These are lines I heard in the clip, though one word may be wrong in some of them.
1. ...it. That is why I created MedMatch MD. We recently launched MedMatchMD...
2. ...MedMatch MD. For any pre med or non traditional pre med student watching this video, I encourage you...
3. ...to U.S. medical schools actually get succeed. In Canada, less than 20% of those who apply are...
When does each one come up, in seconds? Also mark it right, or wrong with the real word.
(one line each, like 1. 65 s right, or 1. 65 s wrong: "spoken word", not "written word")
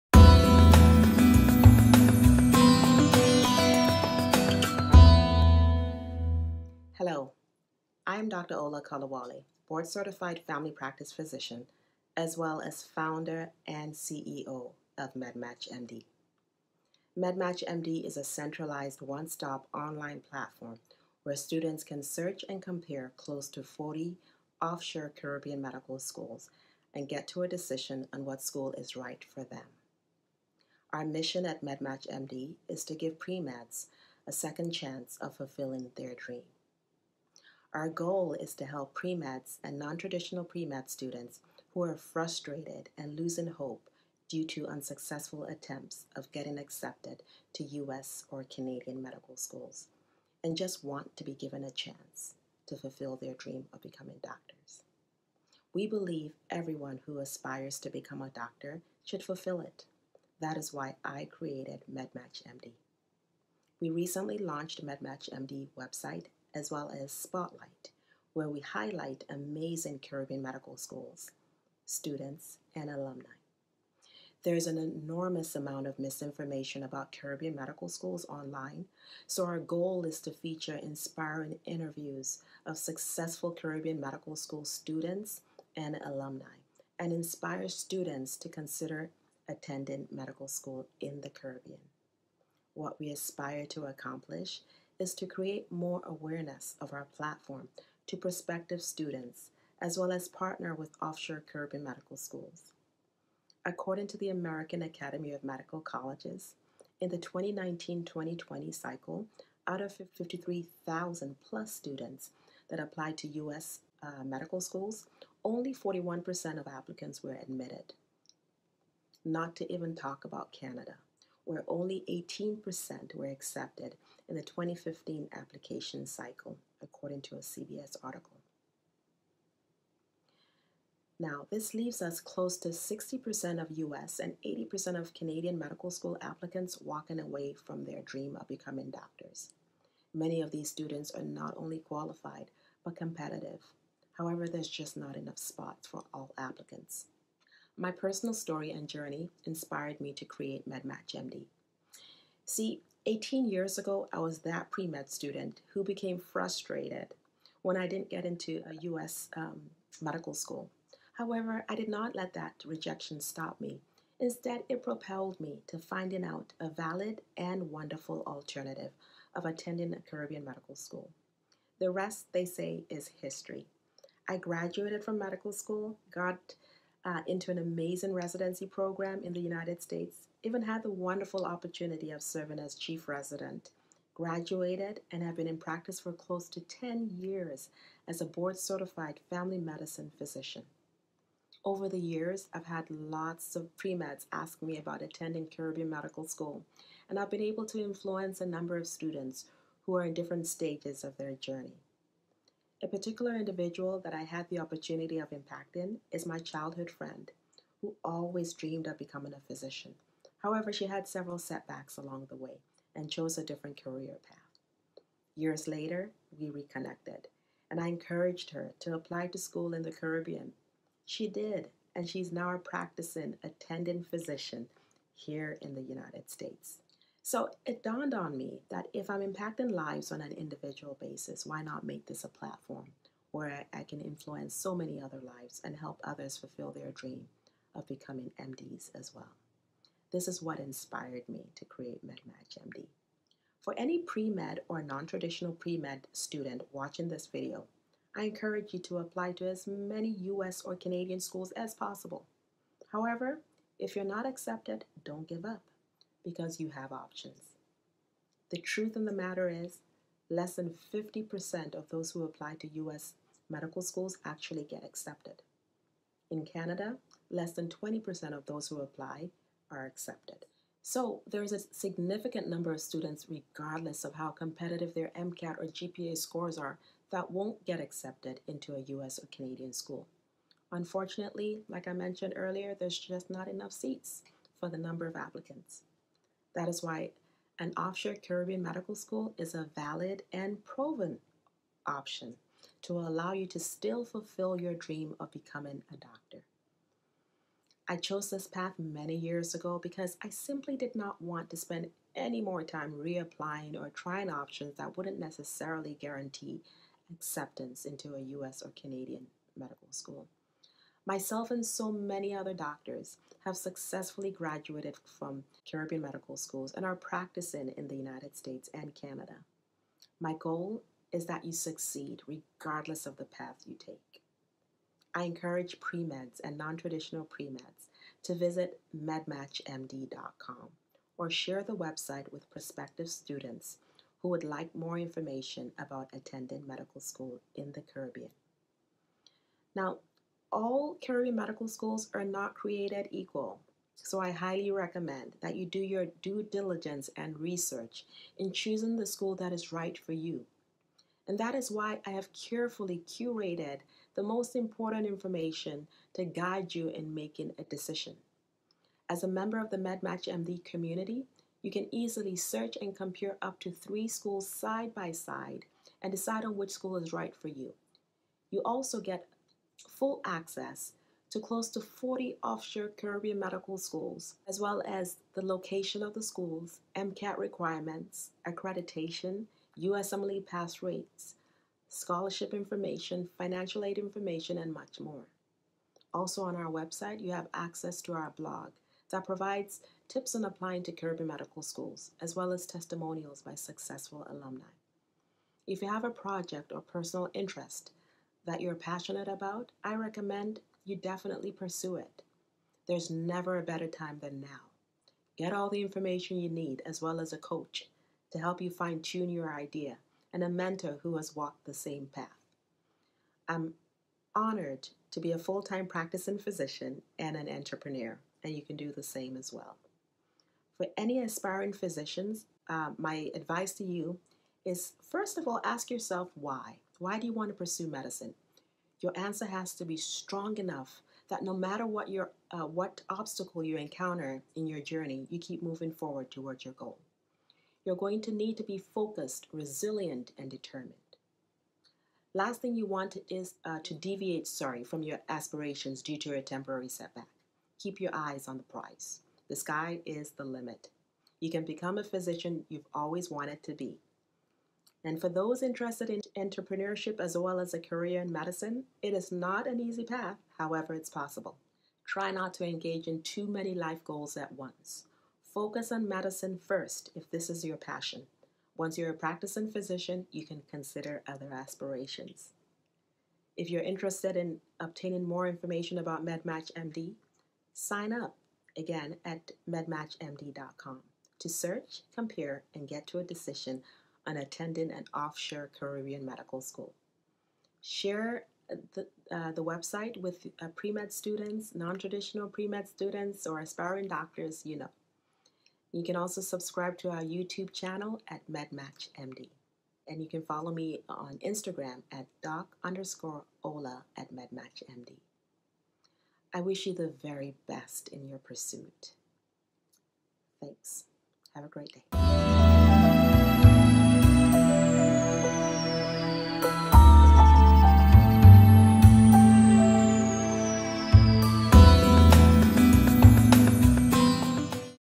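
1. 59 s right
2. 242 s right
3. 262 s wrong: "accepted", not "succeed".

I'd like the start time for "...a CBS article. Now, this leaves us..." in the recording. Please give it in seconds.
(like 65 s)
127 s.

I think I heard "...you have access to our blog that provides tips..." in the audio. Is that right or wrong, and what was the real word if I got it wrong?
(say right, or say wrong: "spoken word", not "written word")
right.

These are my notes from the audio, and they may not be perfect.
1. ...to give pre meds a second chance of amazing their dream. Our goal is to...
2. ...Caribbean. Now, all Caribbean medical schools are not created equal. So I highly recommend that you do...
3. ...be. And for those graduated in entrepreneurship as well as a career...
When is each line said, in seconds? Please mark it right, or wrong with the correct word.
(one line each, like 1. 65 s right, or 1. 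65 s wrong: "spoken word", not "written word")
1. 32 s wrong: "fulfilling", not "amazing"
2. 337 s right
3. 453 s wrong: "interested", not "graduated".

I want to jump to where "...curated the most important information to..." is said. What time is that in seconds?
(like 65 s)
353 s.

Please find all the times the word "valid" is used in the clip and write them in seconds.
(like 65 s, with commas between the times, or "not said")
166 s, 289 s.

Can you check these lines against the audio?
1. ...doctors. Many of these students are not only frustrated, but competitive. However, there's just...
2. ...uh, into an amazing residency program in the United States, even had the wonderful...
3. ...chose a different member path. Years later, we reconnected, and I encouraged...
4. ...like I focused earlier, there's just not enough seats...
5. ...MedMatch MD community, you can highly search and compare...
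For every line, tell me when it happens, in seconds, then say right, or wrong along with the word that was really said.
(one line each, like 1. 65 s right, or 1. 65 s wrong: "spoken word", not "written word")
1. 138 s wrong: "qualified", not "frustrated"
2. 177 s right
3. 213 s wrong: "career", not "member"
4. 281 s wrong: "mentioned", not "focused"
5. 359 s wrong: "easily", not "highly".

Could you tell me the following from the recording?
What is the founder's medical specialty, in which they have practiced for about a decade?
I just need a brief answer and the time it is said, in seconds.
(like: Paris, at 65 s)
family medicine, at 189 s.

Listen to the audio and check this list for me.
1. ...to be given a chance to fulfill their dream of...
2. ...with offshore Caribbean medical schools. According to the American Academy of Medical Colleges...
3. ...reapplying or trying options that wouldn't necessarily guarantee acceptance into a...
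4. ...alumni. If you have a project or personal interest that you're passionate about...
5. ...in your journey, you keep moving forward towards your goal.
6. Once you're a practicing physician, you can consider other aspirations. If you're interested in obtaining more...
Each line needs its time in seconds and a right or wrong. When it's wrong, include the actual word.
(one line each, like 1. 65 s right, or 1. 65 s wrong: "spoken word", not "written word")
1. 51 s right
2. 100 s right
3. 302 s right
4. 394 s right
5. 434 s right
6. 468 s right.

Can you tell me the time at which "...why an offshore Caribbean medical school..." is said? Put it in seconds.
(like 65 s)
286 s.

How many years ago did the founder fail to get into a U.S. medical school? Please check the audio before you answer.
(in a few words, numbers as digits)
18 years.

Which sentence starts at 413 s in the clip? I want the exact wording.
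I'm honored to be a full time practicing physician and an entrepreneur, and you can do the same as well.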